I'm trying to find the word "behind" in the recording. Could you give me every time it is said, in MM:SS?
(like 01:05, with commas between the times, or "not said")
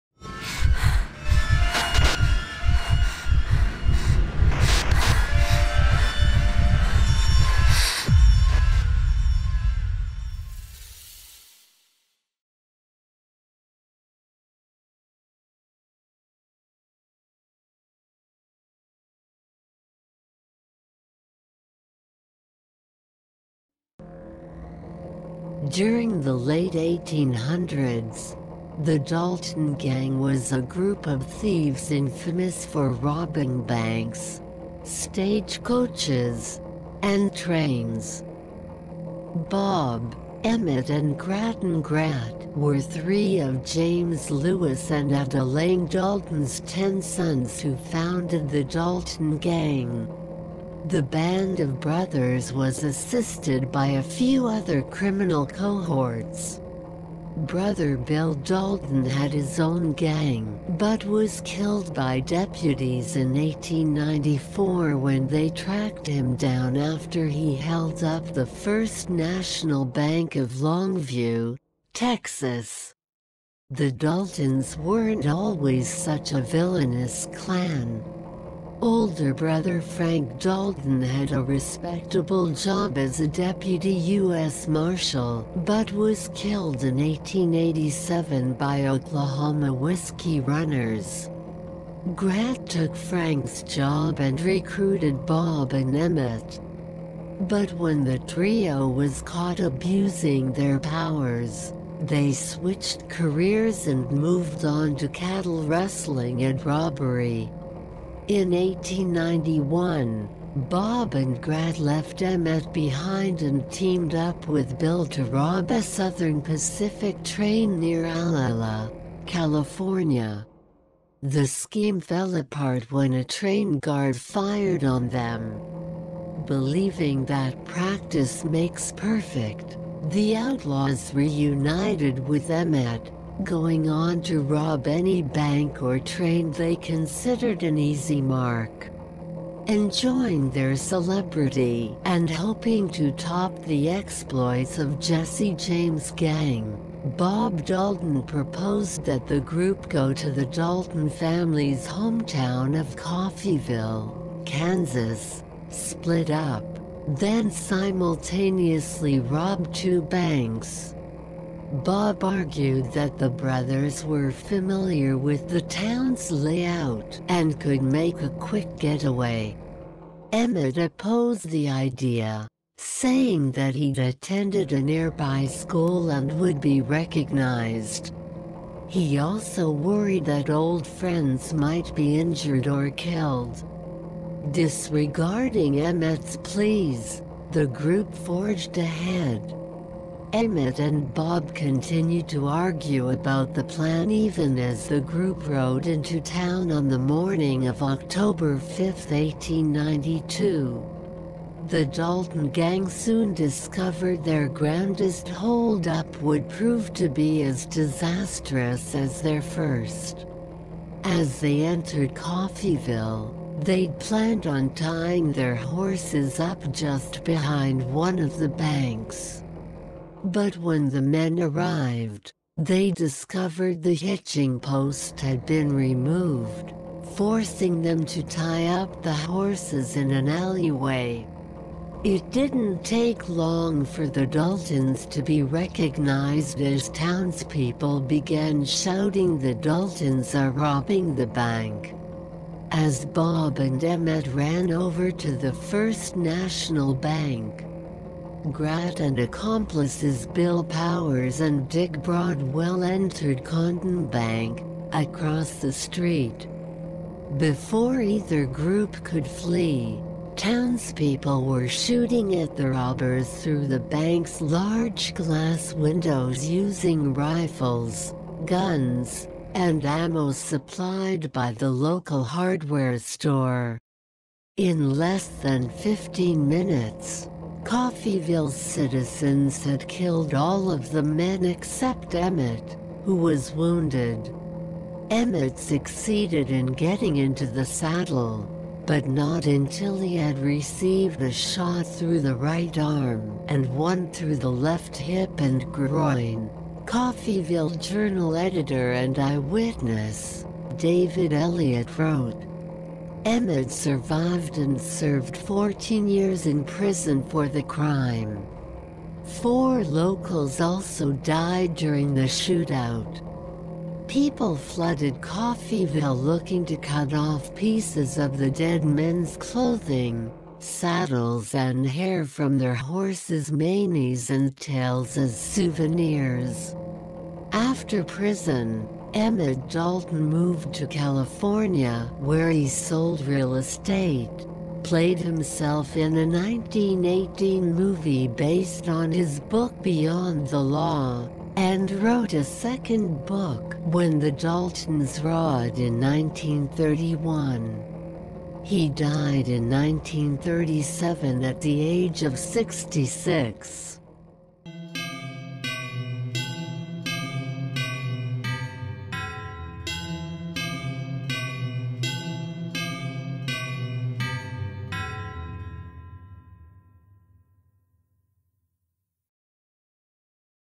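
01:52, 03:37.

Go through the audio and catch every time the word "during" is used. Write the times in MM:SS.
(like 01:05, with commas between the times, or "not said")
00:25, 05:11.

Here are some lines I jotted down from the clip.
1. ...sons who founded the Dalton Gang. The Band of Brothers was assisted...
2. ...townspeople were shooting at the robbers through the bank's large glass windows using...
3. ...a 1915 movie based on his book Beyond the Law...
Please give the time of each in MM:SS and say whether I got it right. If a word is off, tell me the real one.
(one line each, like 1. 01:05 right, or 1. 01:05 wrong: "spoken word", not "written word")
1. 00:47 right
2. 04:20 right
3. 05:36 wrong: "1918", not "1915".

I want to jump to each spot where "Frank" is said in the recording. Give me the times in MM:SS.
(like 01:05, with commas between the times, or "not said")
01:19, 01:32.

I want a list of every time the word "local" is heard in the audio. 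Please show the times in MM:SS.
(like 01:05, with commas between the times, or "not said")
04:31, 05:09.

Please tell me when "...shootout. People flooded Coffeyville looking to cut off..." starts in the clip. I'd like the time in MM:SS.
05:12.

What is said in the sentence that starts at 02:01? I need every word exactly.
The scheme fell apart when a train guard fired on them.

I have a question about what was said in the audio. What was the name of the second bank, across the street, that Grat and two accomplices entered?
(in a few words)
Condon Bank.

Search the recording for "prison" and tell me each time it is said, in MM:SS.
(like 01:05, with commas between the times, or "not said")
05:06, 05:28.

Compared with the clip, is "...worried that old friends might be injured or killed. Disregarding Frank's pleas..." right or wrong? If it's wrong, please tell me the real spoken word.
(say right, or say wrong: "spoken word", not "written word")
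wrong: "Emmett", not "Frank".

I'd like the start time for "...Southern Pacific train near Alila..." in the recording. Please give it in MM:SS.
01:55.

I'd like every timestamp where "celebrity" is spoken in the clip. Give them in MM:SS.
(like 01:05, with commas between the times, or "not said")
02:20.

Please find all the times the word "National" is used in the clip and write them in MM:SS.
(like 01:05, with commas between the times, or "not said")
01:09, 04:06.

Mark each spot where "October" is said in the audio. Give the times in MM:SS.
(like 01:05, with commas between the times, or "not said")
03:17.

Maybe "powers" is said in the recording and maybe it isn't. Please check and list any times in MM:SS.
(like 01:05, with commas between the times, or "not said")
01:40, 04:10.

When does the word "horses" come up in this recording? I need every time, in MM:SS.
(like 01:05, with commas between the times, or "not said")
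03:35, 03:49, 05:22.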